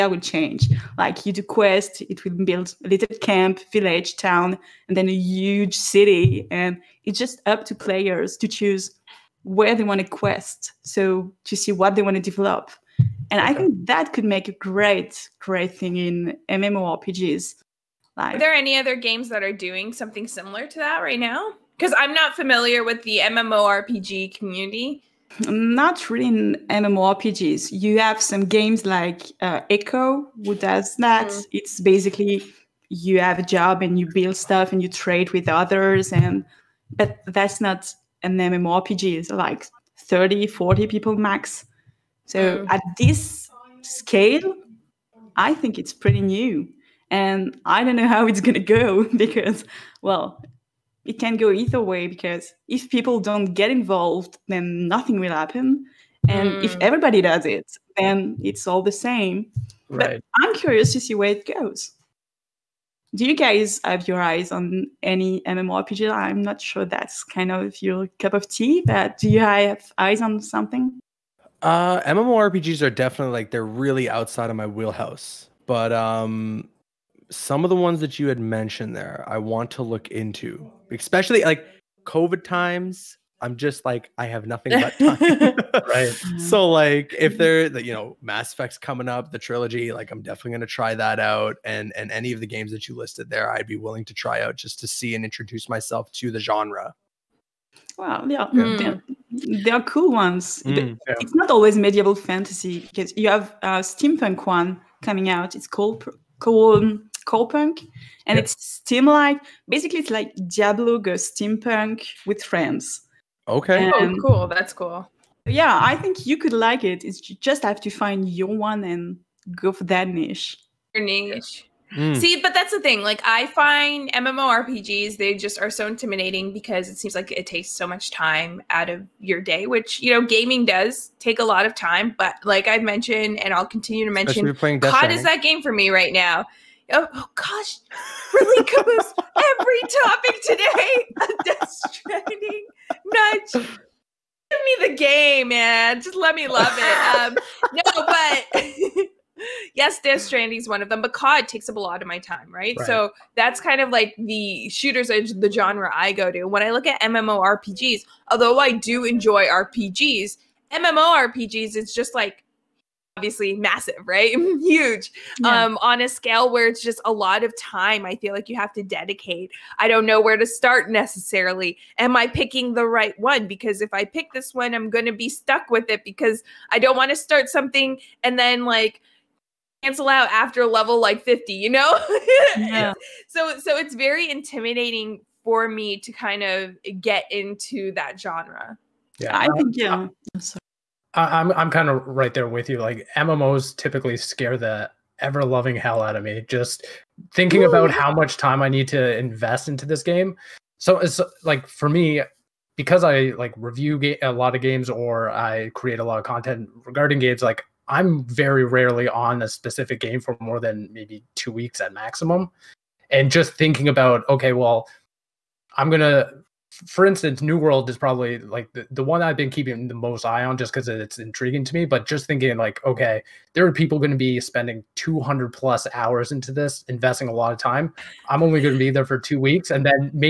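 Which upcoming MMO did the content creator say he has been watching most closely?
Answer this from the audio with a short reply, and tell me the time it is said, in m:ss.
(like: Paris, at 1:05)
New World, at 3:37.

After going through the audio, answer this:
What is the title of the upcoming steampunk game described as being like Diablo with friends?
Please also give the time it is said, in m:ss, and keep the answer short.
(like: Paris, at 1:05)
Corepunk, at 1:47.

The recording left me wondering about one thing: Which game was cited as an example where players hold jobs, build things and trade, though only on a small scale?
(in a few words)
Eco.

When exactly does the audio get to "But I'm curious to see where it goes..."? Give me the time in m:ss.
1:00.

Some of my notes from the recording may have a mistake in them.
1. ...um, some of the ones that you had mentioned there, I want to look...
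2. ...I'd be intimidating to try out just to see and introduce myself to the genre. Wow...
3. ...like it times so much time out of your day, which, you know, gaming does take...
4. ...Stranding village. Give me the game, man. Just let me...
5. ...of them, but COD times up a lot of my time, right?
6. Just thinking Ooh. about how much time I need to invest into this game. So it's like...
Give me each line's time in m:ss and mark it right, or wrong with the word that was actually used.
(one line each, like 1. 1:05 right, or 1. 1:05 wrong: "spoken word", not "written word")
1. 1:15 right
2. 1:33 wrong: "willing", not "intimidating"
3. 2:07 wrong: "takes", not "times"
4. 2:21 wrong: "nudge", not "village"
5. 2:30 wrong: "takes", not "times"
6. 3:16 right.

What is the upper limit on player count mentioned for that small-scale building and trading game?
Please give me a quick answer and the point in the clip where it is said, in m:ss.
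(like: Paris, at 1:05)
40, at 0:40.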